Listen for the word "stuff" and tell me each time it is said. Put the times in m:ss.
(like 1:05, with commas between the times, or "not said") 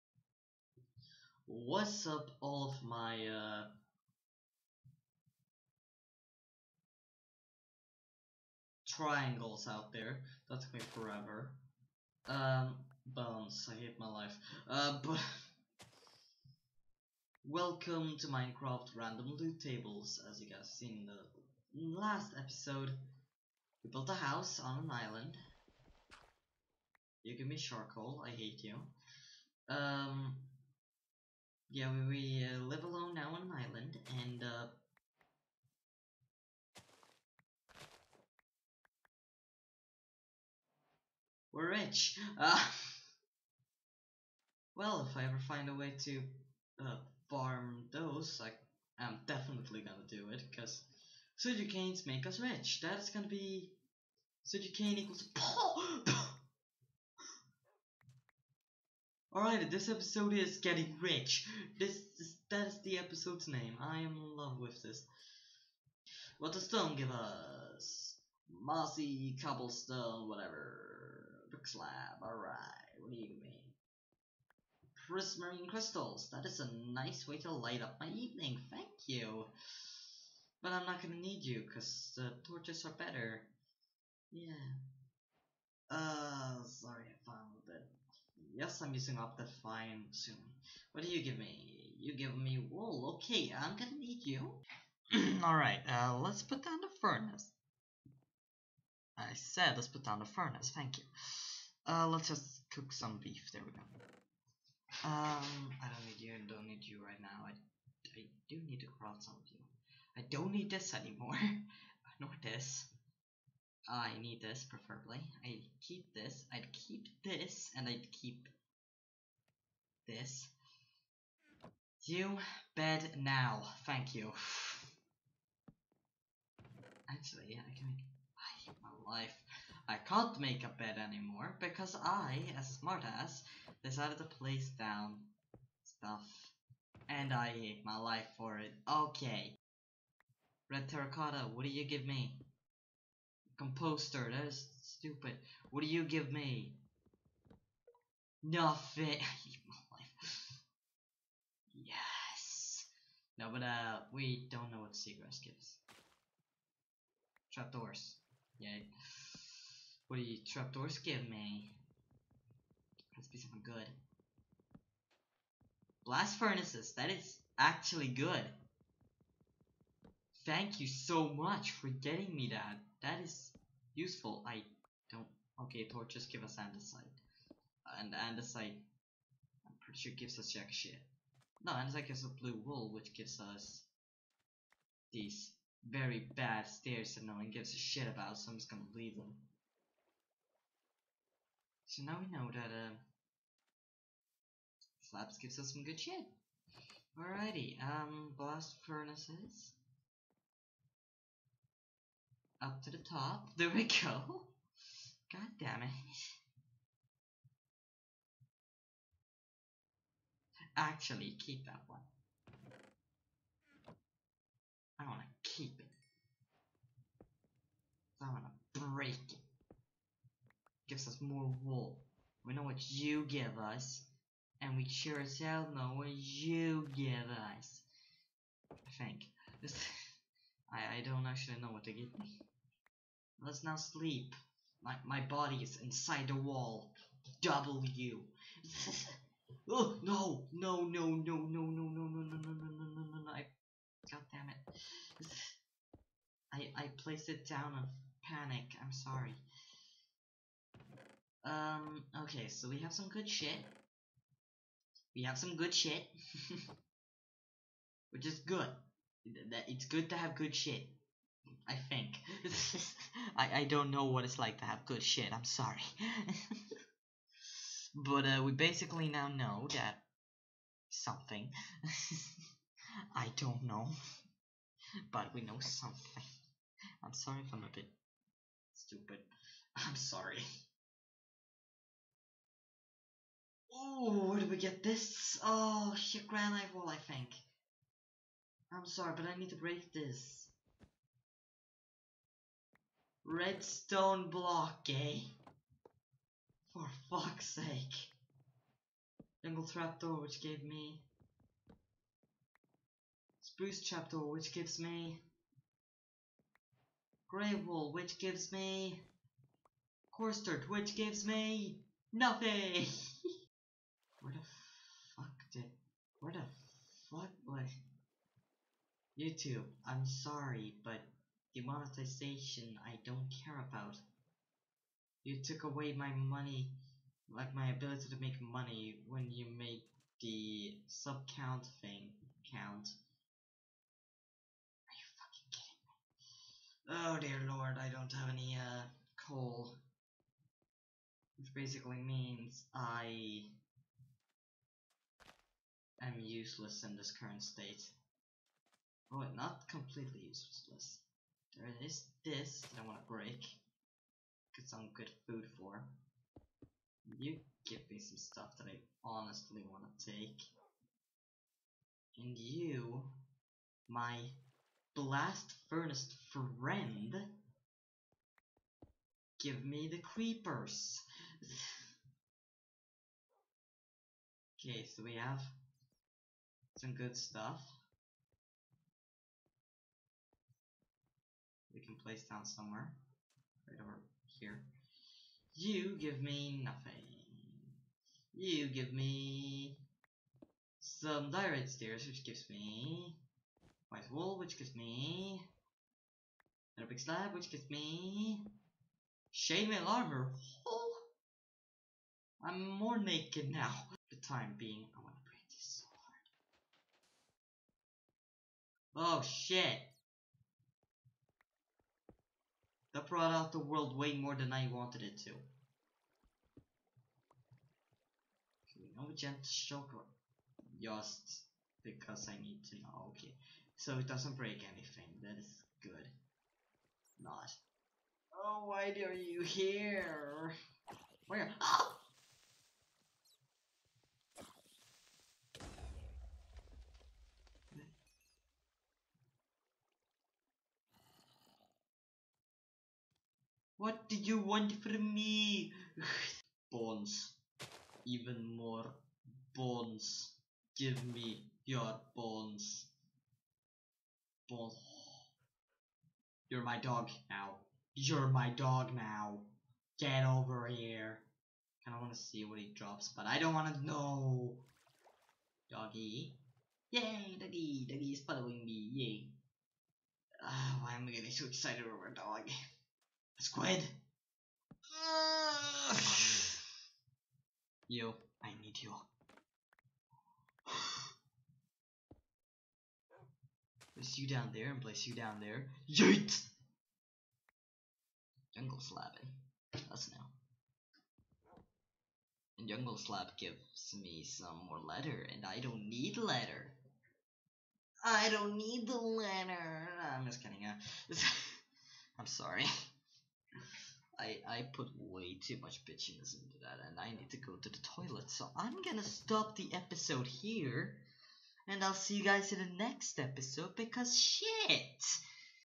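2:15, 5:58, 6:17.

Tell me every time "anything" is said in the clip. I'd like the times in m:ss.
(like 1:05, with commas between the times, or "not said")
7:04.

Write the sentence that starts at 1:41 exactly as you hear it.
Uh, let's just cook some beef, there we go.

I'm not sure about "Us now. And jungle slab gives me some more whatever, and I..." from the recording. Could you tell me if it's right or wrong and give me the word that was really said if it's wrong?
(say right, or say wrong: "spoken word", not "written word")
wrong: "letter", not "whatever".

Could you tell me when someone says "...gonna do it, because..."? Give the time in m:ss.
0:49.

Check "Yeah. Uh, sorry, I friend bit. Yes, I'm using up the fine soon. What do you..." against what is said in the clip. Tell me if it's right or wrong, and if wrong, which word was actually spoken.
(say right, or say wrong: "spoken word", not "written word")
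wrong: "found", not "friend".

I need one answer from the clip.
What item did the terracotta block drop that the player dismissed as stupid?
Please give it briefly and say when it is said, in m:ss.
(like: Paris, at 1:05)
Composter, at 2:23.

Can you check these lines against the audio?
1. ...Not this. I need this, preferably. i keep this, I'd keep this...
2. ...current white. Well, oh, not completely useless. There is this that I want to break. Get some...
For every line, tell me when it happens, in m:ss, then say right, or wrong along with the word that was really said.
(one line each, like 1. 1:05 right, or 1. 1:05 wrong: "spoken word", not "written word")
1. 1:52 right
2. 5:47 wrong: "state", not "white".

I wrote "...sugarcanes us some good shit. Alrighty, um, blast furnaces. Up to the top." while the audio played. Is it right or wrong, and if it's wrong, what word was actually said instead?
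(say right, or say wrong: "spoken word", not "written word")
wrong: "gives", not "sugarcanes".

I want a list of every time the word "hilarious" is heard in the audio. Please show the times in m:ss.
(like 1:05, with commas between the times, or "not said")
not said.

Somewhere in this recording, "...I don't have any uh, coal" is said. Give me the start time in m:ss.
5:37.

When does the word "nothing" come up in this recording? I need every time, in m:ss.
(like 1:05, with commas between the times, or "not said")
2:28, 5:12, 6:26.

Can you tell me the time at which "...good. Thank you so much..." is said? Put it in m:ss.
2:48.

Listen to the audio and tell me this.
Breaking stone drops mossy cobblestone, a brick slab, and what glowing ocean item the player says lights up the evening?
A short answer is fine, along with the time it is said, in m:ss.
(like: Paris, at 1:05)
Prismarine crystals, at 1:15.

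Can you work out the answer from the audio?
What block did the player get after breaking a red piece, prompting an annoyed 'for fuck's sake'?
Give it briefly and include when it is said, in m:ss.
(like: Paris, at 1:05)
Redstone block, at 4:53.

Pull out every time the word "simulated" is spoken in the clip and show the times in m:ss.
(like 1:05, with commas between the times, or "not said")
not said.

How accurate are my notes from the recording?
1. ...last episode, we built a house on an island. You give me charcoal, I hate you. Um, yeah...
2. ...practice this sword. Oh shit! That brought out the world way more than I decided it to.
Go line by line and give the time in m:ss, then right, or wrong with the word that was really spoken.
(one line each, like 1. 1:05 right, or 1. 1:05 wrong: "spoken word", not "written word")
1. 0:21 right
2. 6:45 wrong: "wanted", not "decided".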